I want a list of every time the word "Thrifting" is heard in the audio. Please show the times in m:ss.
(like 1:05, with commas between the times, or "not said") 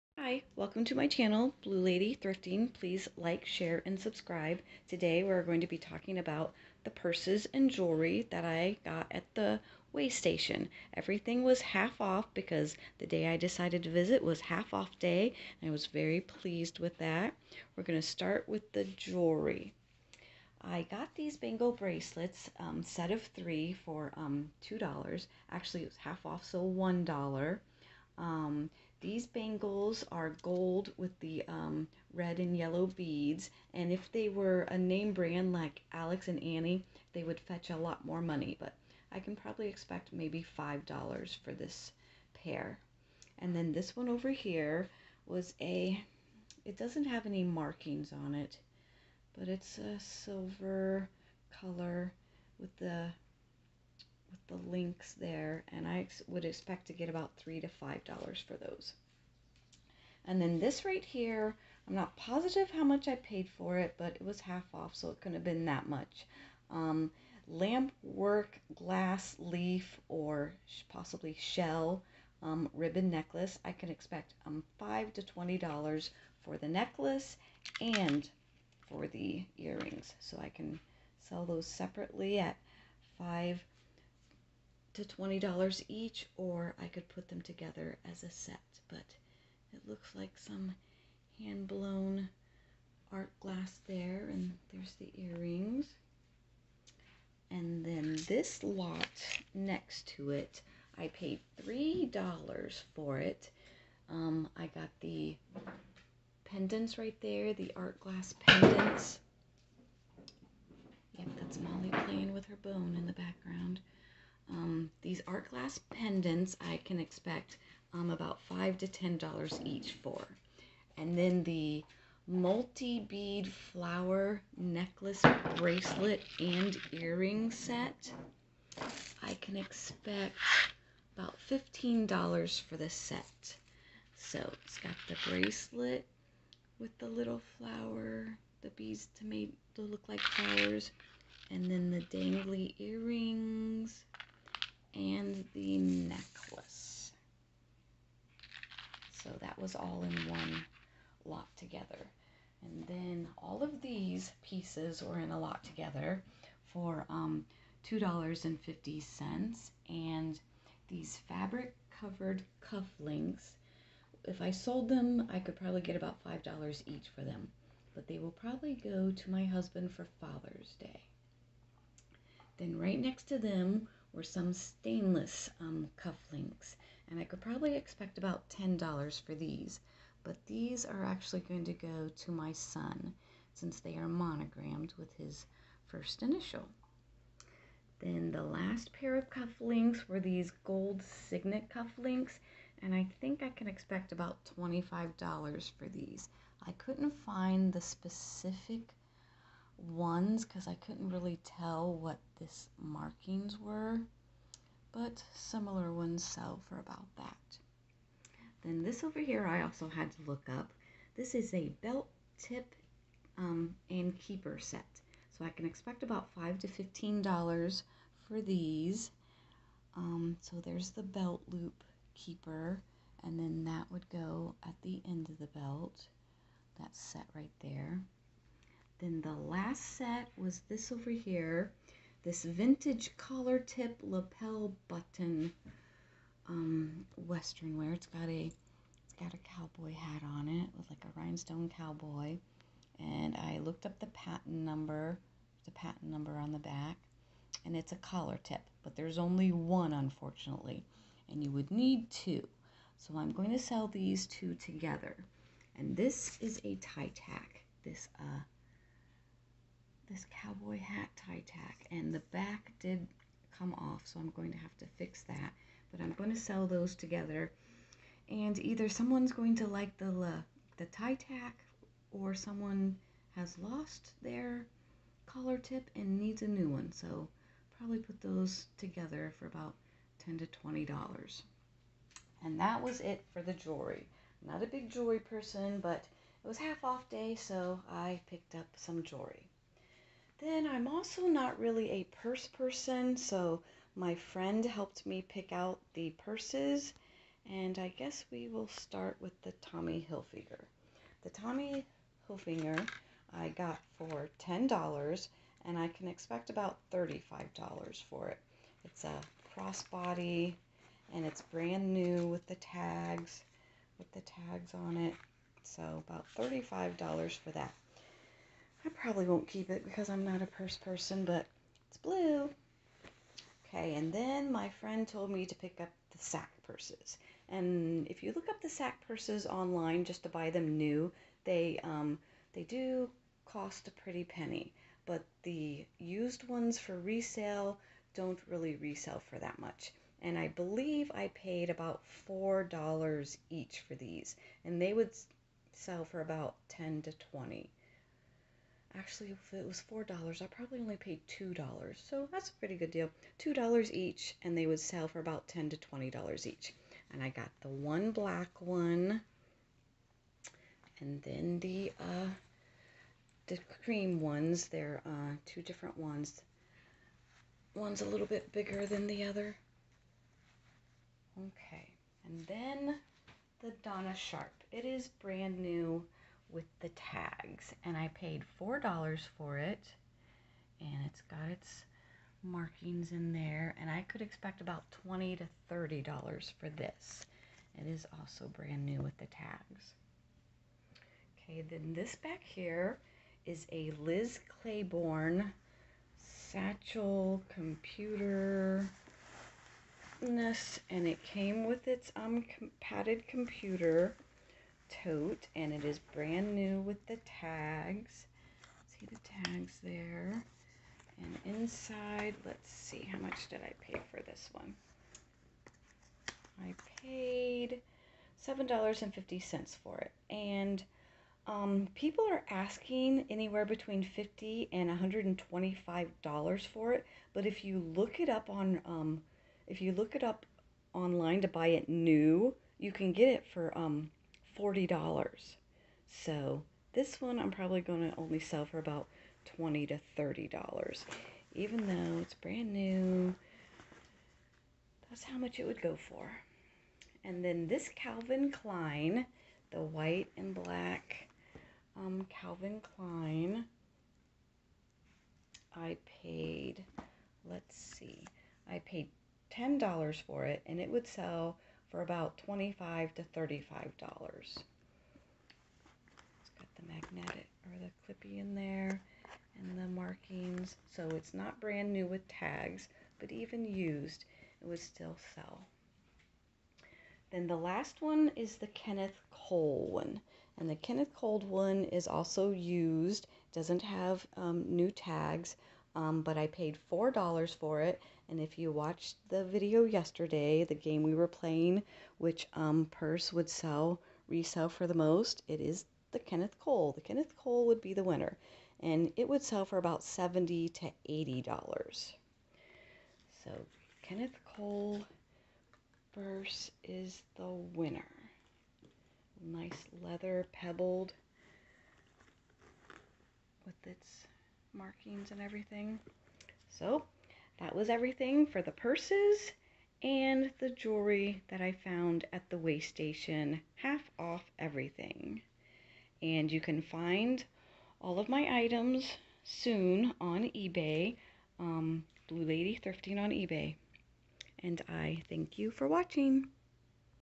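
0:02, 8:52.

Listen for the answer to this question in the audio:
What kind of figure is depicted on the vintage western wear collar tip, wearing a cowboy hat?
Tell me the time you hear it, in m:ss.
4:01.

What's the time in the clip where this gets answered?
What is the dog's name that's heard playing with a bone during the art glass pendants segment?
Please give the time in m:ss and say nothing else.
1:51.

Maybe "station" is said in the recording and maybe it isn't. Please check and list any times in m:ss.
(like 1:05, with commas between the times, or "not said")
0:10, 8:42.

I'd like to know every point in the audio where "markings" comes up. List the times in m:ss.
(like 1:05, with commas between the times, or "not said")
0:47, 3:22, 6:22, 7:49, 8:34.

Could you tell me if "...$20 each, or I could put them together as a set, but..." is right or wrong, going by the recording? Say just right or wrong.
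right.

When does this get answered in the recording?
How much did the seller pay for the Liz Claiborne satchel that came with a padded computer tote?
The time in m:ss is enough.
6:58.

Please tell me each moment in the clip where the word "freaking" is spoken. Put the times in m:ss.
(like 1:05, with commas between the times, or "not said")
not said.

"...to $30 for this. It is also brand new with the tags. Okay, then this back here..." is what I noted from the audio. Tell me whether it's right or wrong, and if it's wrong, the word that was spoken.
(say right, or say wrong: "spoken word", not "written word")
right.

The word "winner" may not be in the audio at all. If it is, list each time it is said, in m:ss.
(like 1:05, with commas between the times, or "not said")
8:18, 8:27.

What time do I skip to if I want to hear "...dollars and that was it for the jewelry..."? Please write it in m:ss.
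4:40.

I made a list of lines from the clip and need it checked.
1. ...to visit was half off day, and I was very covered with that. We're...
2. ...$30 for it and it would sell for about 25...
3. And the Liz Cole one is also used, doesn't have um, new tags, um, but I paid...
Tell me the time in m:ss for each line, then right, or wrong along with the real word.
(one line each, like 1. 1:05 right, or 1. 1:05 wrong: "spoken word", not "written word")
1. 0:13 wrong: "pleased", not "covered"
2. 7:39 wrong: "10", not "30"
3. 8:00 wrong: "Kenneth", not "Liz".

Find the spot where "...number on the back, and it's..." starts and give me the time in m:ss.
4:06.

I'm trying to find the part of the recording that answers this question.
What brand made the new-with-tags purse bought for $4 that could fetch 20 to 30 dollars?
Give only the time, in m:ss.
6:13.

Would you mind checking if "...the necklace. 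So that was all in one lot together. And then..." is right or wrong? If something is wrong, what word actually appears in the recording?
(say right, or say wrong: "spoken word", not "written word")
right.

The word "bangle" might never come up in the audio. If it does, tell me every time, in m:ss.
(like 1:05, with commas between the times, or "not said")
0:21, 0:29.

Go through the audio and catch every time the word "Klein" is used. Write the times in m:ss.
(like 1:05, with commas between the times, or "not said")
7:28, 7:32.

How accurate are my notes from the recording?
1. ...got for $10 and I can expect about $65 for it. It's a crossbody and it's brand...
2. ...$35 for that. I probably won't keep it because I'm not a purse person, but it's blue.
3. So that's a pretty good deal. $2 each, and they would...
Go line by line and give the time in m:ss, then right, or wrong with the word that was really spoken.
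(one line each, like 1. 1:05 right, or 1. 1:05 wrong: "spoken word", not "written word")
1. 5:03 wrong: "35", not "65"
2. 5:16 right
3. 5:52 right.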